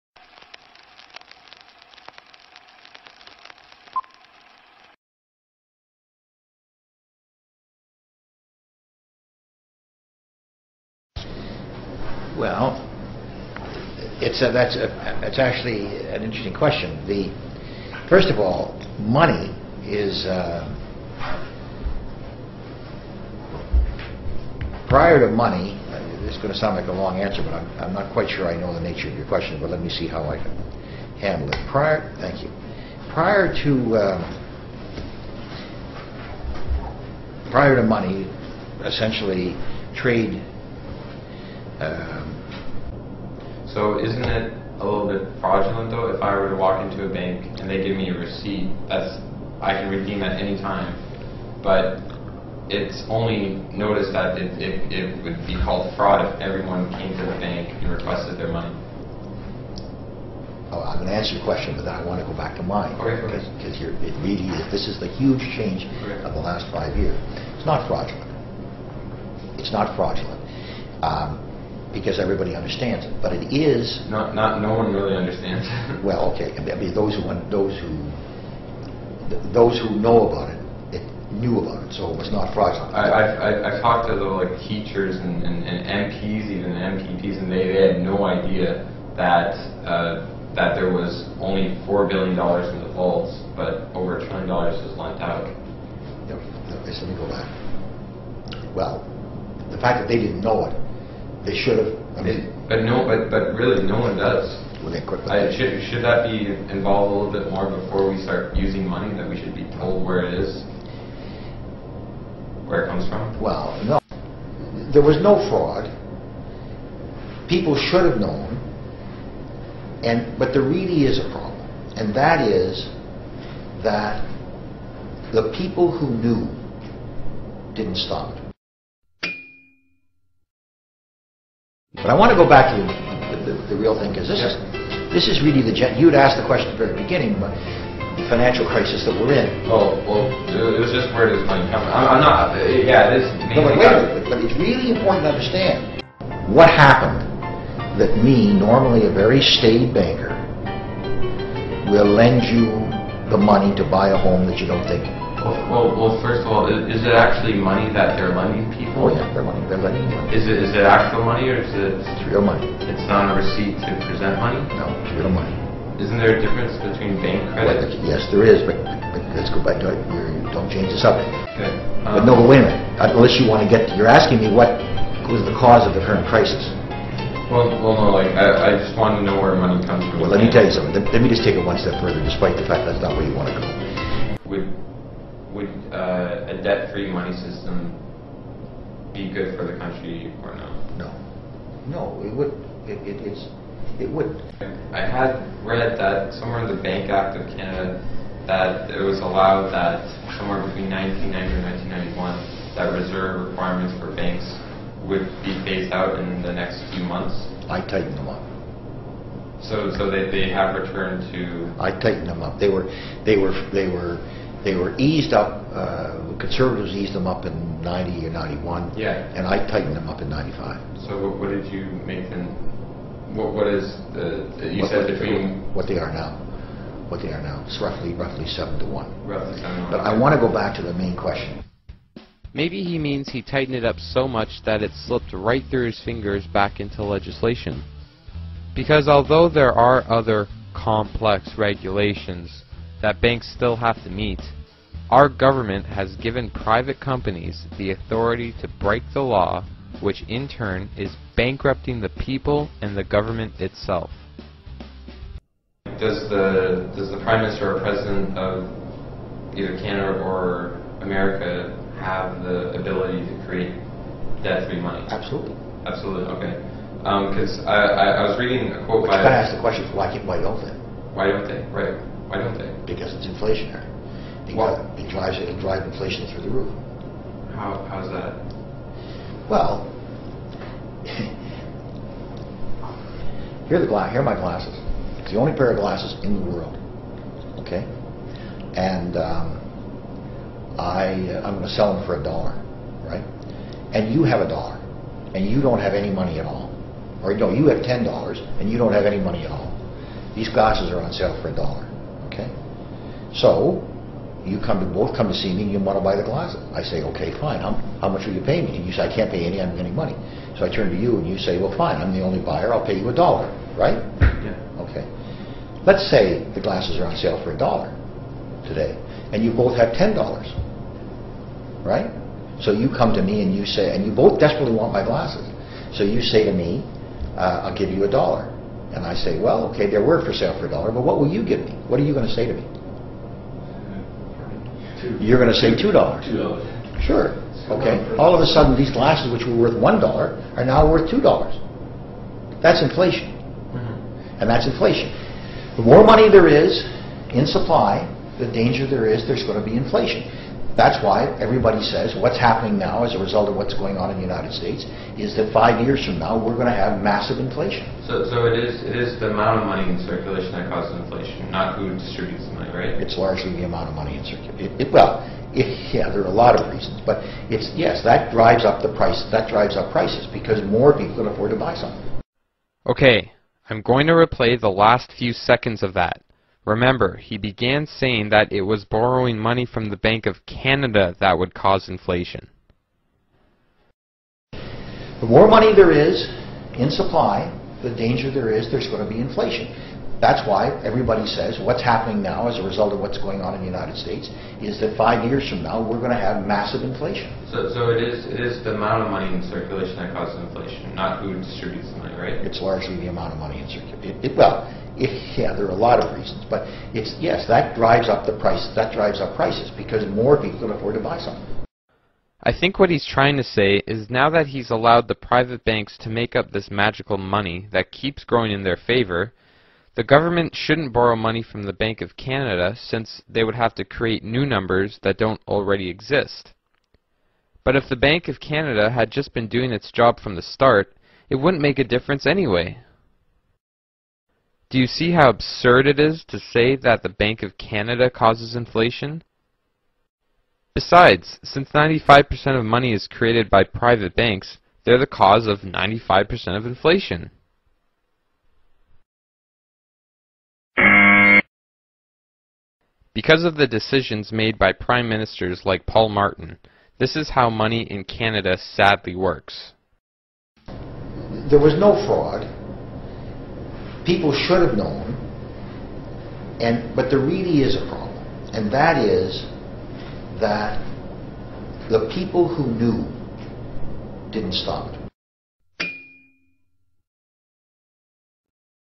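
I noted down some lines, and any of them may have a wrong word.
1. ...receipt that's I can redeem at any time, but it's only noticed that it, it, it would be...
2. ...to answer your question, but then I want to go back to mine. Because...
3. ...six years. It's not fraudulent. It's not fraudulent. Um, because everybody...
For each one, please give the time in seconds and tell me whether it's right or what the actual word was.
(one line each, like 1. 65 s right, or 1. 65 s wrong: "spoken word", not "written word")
1. 48 s right
2. 61 s right
3. 66 s wrong: "five", not "six".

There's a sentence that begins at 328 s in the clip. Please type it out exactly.
And I say, well, okay, they're worth for sale for a dollar, but what will you give me?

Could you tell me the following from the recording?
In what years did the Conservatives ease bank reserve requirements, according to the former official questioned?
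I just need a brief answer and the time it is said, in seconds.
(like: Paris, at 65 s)
90 or 91, at 217 s.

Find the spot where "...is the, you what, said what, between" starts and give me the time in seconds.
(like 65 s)
223 s.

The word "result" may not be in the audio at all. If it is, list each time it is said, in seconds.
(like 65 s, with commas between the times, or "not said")
353 s, 392 s.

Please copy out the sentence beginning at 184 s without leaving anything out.
With would uh, a debt-free money system be good for the country or no?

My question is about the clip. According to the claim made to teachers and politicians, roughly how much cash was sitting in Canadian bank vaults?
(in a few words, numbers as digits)
4 billion dollars.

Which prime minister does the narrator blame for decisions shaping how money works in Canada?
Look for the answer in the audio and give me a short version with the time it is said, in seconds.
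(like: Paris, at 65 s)
Paul Martin, at 455 s.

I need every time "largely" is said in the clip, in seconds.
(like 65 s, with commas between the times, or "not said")
363 s, 402 s.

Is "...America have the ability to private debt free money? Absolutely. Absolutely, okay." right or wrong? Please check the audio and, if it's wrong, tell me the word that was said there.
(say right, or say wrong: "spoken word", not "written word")
wrong: "create", not "private".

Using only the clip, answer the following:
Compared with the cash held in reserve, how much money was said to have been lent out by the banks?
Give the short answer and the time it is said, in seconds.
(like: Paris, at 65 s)
over a trillion dollars, at 93 s.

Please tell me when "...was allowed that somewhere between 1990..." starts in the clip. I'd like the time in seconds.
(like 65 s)
199 s.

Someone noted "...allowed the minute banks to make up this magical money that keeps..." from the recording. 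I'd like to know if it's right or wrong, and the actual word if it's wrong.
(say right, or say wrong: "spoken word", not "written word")
wrong: "private", not "minute".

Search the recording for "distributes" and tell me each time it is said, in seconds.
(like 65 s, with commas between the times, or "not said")
361 s, 401 s.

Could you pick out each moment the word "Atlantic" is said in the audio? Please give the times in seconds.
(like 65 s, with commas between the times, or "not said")
not said.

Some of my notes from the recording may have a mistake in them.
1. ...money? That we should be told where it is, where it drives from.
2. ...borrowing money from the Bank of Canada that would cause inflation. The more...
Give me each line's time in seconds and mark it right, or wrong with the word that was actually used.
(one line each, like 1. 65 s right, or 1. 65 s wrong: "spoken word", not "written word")
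1. 108 s wrong: "comes", not "drives"
2. 378 s right.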